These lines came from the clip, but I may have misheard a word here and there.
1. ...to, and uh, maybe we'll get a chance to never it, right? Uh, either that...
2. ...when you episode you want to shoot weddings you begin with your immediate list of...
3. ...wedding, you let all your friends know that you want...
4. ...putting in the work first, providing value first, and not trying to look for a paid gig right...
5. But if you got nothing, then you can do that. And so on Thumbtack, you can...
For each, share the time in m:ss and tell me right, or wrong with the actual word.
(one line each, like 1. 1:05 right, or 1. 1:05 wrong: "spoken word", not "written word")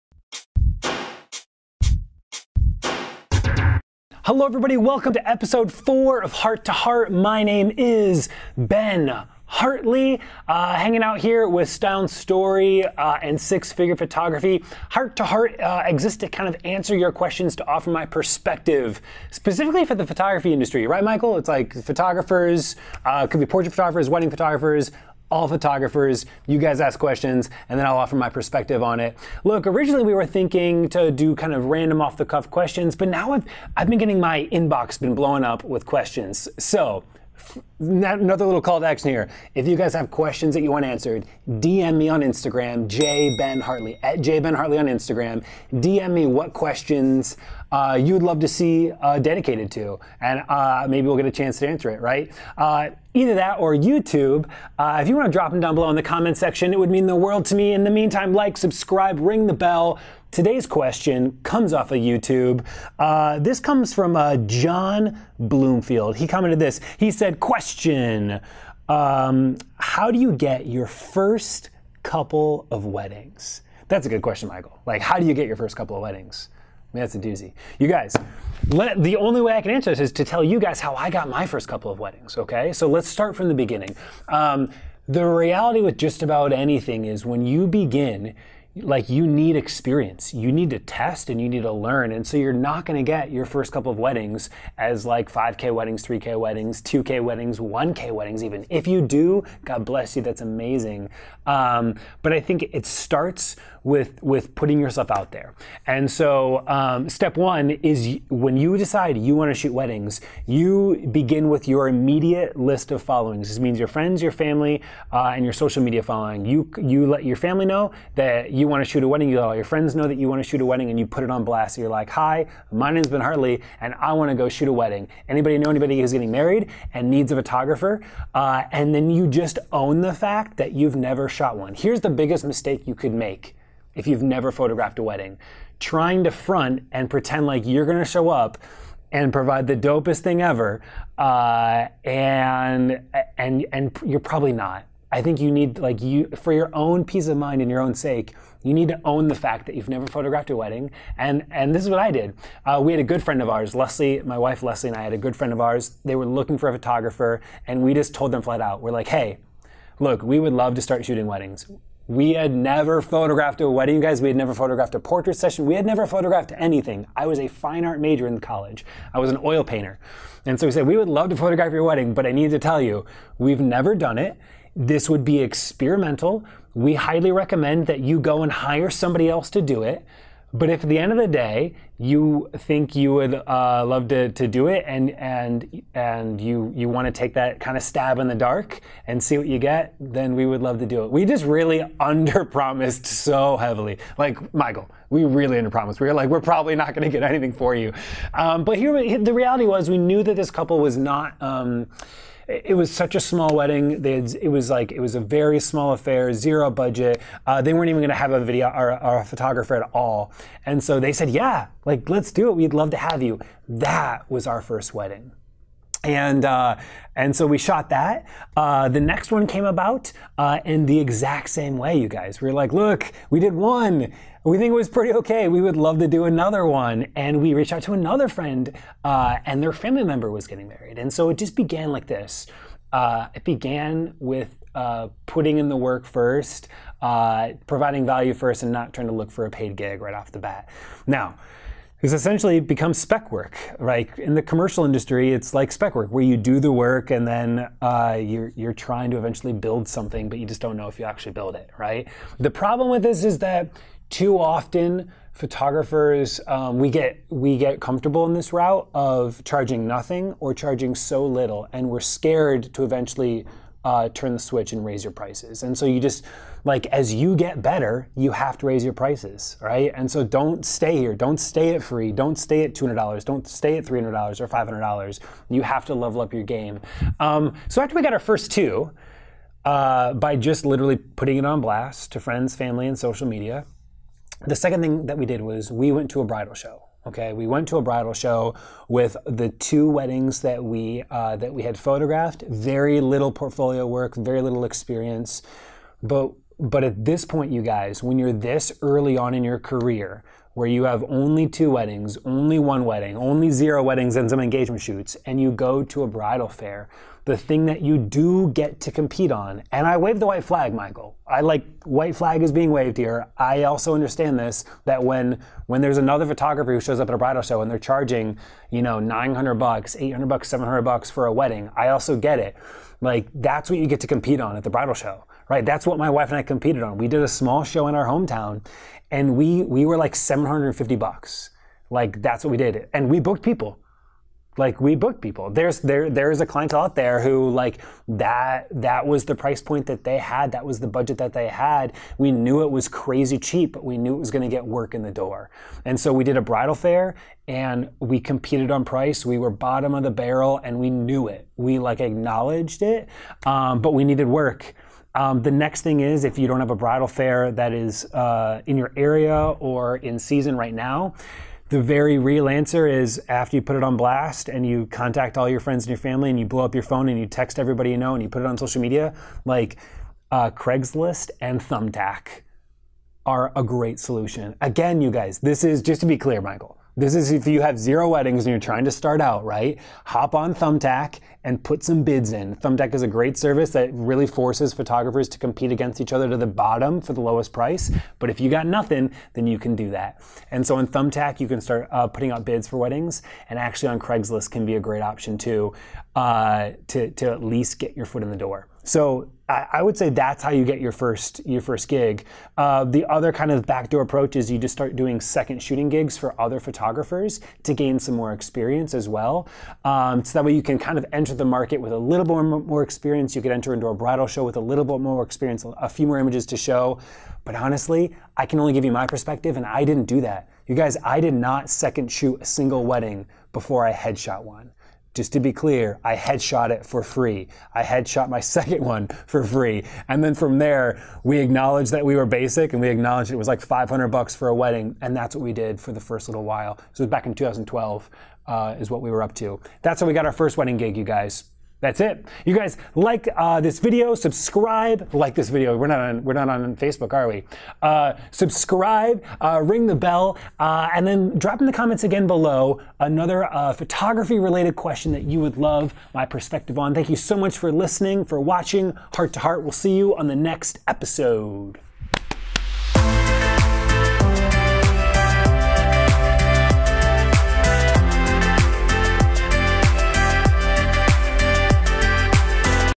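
1. 0:49 wrong: "answer", not "never"
2. 1:48 wrong: "decide", not "episode"
3. 1:59 right
4. 3:55 right
5. 6:28 right.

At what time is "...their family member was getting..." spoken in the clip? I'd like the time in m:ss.
3:49.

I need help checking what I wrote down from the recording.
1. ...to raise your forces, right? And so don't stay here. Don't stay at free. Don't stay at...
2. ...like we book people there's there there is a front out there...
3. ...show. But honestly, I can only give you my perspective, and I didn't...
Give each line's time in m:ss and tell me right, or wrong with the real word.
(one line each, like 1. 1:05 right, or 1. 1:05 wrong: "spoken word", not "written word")
1. 4:28 wrong: "prices", not "forces"
2. 5:34 wrong: "client", not "front"
3. 6:56 right.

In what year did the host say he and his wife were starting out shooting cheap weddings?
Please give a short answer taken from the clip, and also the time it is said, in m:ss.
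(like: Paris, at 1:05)
2012, at 7:17.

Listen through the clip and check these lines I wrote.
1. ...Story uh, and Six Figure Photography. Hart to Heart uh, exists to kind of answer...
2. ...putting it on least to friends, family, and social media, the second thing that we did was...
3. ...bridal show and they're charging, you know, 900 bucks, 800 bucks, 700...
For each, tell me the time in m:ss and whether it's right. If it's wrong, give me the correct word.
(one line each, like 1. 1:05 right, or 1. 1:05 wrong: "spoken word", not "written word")
1. 0:12 right
2. 4:40 wrong: "blast", not "least"
3. 5:17 right.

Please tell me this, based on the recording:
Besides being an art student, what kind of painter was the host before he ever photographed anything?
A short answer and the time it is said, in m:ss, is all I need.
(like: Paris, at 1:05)
Oil painter, at 2:49.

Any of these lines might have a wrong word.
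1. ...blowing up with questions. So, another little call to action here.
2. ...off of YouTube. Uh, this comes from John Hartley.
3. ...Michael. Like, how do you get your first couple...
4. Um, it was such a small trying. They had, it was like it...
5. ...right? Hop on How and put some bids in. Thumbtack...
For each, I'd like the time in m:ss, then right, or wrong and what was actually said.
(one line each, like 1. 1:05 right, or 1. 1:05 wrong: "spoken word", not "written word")
1. 0:35 right
2. 1:01 wrong: "Bloomfield", not "Hartley"
3. 1:14 right
4. 3:21 wrong: "wedding", not "trying"
5. 6:19 wrong: "Thumbtack", not "How".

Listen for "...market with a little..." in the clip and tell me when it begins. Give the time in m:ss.
6:51.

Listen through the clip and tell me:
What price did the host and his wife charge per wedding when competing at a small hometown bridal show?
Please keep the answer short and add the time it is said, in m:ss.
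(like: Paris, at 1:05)
$750, at 5:30.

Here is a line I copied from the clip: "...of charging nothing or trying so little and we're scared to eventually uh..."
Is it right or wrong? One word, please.
wrong.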